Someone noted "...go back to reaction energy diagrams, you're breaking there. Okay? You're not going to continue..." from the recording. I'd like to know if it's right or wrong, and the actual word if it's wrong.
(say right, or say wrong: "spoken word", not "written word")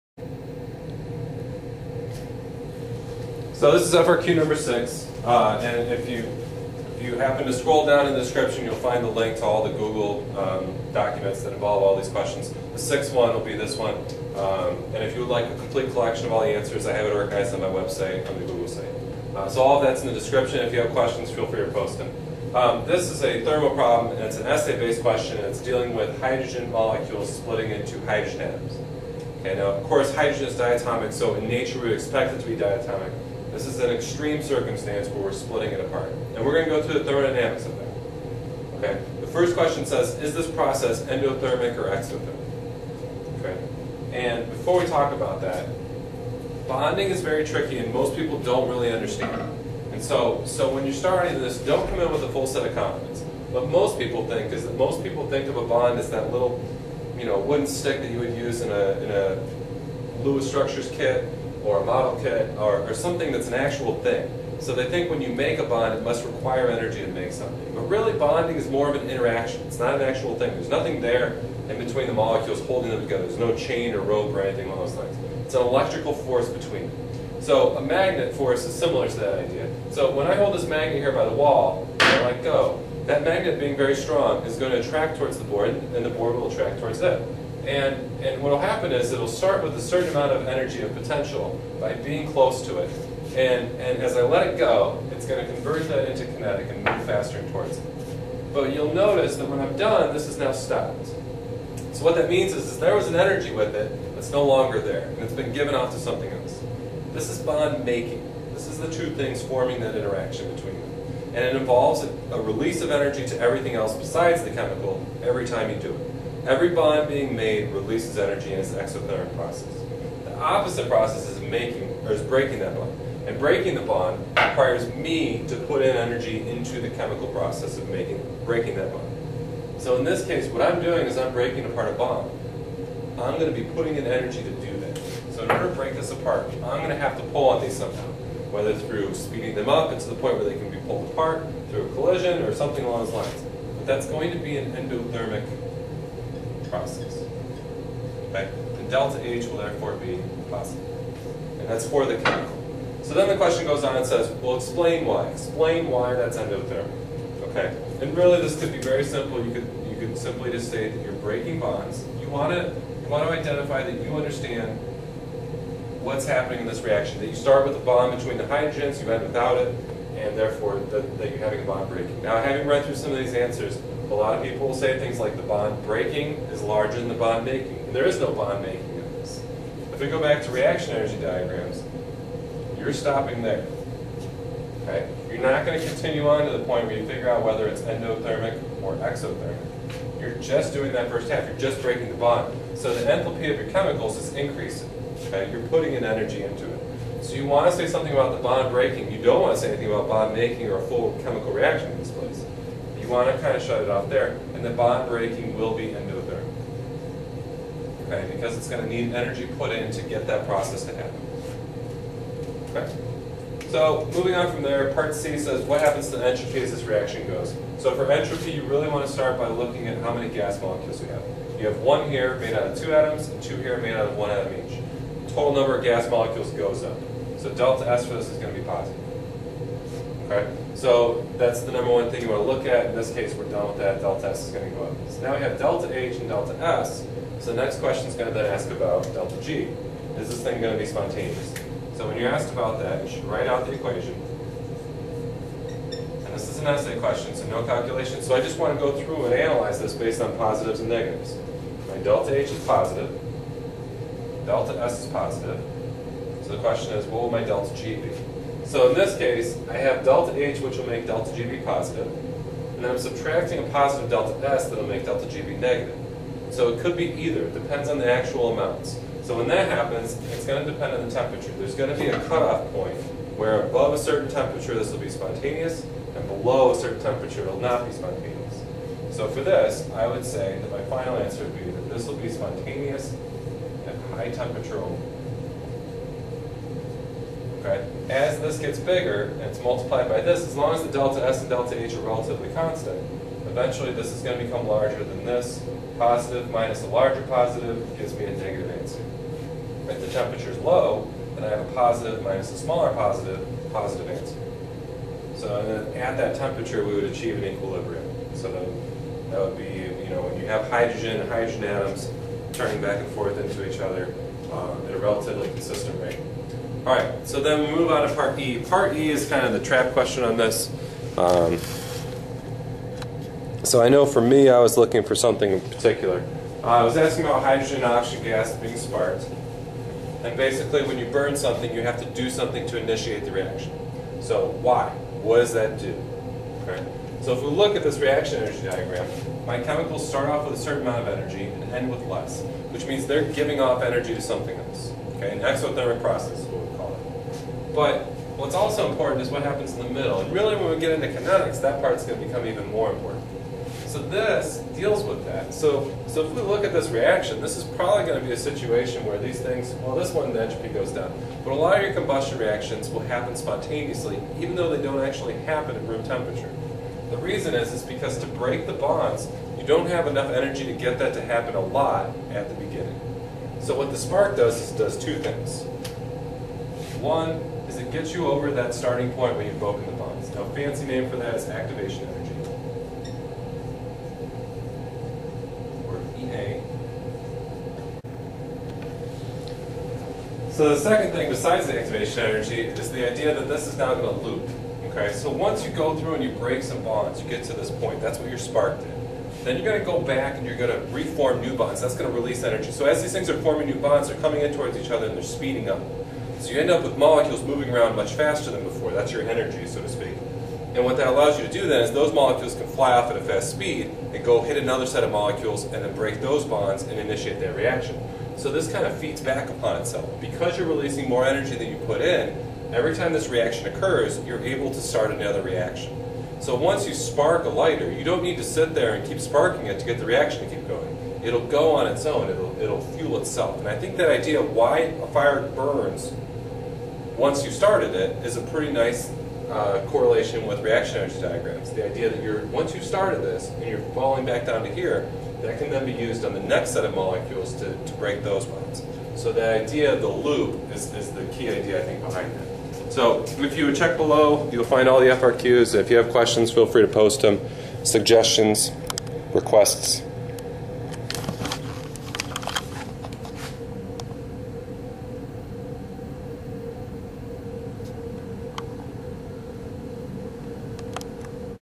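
wrong: "stopping", not "breaking".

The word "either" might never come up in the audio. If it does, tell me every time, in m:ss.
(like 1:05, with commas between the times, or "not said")
4:27.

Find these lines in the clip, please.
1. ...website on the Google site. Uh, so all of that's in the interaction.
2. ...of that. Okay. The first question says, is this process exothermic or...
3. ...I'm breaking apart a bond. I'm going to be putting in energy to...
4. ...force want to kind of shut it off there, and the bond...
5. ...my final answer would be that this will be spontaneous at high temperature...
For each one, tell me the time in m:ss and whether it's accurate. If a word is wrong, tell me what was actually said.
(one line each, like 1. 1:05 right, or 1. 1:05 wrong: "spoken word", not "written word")
1. 0:17 wrong: "description", not "interaction"
2. 0:37 wrong: "endothermic", not "exothermic"
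3. 2:11 right
4. 3:22 wrong: "place", not "force"
5. 4:40 right.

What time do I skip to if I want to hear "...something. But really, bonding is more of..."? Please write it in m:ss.
1:07.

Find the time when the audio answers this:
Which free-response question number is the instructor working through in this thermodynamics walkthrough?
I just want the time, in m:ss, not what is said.
0:03.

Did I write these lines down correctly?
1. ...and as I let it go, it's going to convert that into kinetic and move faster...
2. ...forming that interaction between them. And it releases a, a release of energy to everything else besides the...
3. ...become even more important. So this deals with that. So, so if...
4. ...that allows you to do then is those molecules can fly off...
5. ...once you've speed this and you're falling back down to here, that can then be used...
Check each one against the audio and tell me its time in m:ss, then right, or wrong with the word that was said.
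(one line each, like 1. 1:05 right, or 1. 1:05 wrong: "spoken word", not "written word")
1. 1:33 right
2. 1:49 wrong: "involves", not "releases"
3. 5:52 right
4. 6:50 right
5. 7:22 wrong: "started", not "speed".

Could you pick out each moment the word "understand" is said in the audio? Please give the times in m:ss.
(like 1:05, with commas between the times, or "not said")
0:48, 2:44.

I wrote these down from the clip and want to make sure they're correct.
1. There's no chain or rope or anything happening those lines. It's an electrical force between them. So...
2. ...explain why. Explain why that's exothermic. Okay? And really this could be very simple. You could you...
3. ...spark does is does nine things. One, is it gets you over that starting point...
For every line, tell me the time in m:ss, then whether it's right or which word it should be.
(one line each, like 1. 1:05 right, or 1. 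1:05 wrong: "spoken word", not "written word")
1. 1:13 wrong: "along", not "happening"
2. 2:34 wrong: "endothermic", not "exothermic"
3. 6:13 wrong: "two", not "nine".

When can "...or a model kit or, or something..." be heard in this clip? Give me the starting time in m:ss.
1:01.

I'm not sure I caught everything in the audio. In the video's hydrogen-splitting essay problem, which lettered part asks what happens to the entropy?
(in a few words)
Part C.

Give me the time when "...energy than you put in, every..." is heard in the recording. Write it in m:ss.
7:01.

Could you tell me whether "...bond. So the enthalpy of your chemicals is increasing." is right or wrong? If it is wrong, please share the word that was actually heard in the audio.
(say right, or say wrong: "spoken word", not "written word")
right.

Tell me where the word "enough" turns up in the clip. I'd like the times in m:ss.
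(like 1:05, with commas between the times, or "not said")
6:10.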